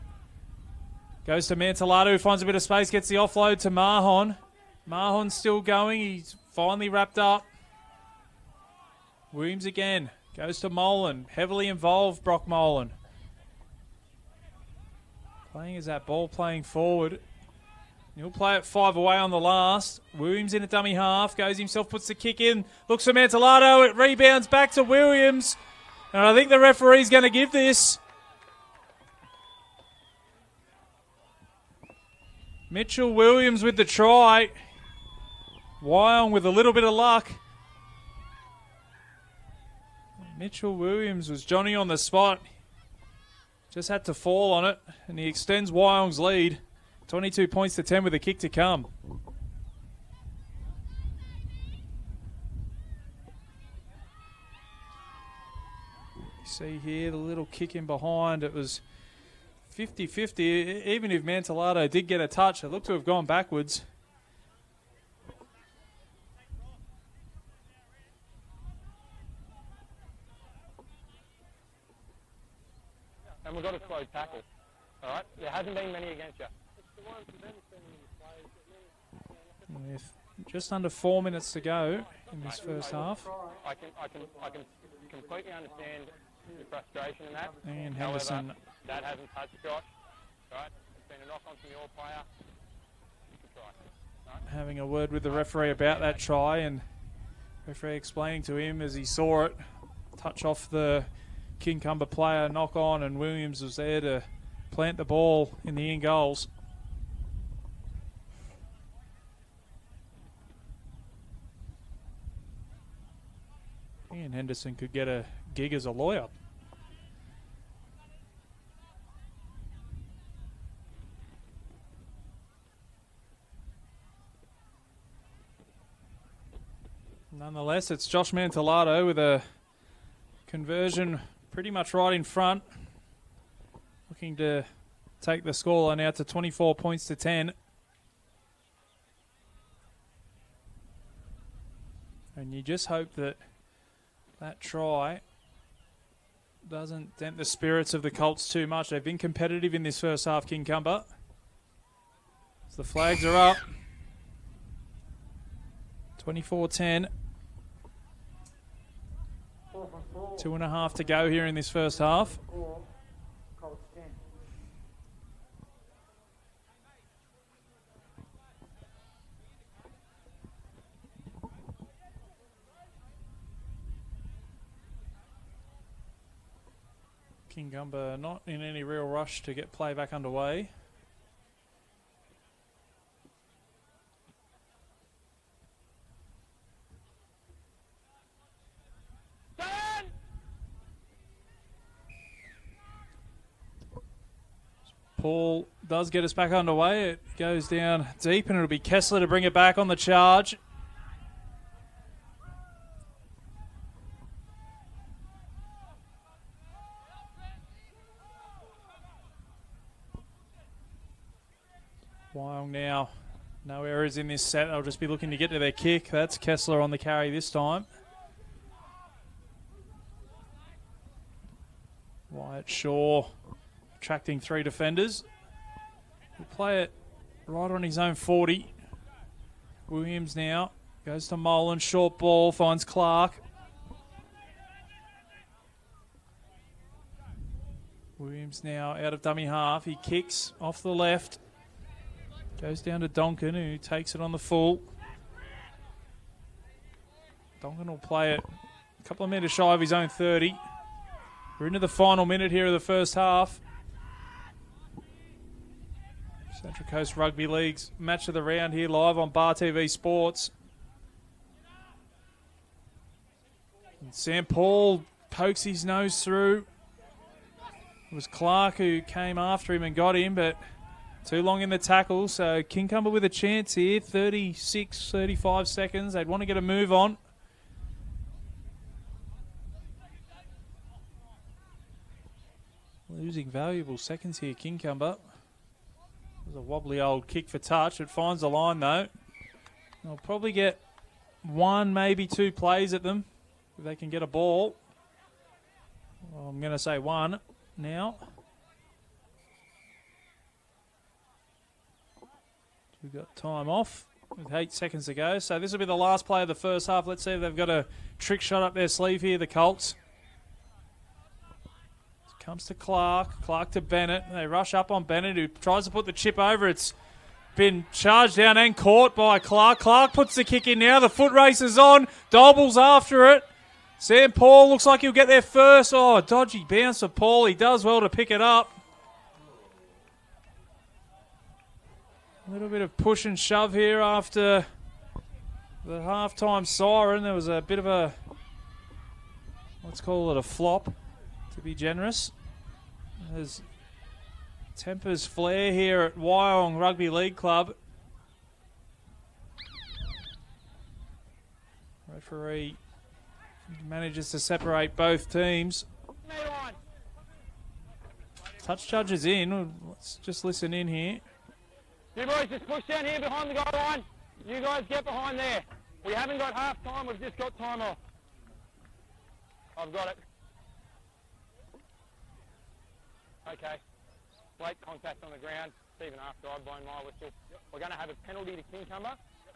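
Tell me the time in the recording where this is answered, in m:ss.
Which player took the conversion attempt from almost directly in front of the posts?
2:08.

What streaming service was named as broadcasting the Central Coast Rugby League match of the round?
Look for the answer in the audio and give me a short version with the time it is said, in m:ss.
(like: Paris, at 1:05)
Bar TV Sports, at 4:19.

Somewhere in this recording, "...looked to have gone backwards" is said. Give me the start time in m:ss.
1:02.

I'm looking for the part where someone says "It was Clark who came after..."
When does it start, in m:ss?
4:28.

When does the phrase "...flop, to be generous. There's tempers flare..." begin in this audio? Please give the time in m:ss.
5:40.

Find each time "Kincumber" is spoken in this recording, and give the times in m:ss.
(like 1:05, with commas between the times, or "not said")
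1:41, 2:30, 2:57, 4:32, 4:44, 6:18.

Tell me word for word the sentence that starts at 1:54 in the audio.
Henderson could get a gig as a lawyer.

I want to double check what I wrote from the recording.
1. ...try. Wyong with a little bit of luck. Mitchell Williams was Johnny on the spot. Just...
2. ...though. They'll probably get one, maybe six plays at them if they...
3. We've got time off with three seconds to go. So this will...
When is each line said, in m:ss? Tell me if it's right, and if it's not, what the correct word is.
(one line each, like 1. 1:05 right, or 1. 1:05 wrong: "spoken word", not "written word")
1. 0:33 right
2. 4:48 wrong: "two", not "six"
3. 5:03 wrong: "eight", not "three".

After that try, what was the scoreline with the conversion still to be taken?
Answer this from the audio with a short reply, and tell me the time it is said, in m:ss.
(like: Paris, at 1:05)
22 to 10, at 0:47.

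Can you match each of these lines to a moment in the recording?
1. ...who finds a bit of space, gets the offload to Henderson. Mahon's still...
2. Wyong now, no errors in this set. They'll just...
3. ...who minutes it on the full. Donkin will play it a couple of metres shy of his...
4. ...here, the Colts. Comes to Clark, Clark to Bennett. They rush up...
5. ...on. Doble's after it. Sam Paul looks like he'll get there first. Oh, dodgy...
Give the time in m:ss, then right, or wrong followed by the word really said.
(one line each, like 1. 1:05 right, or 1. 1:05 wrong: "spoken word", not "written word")
1. 0:02 wrong: "Mahon", not "Henderson"
2. 3:32 right
3. 4:03 wrong: "takes", not "minutes"
4. 5:09 right
5. 5:21 right.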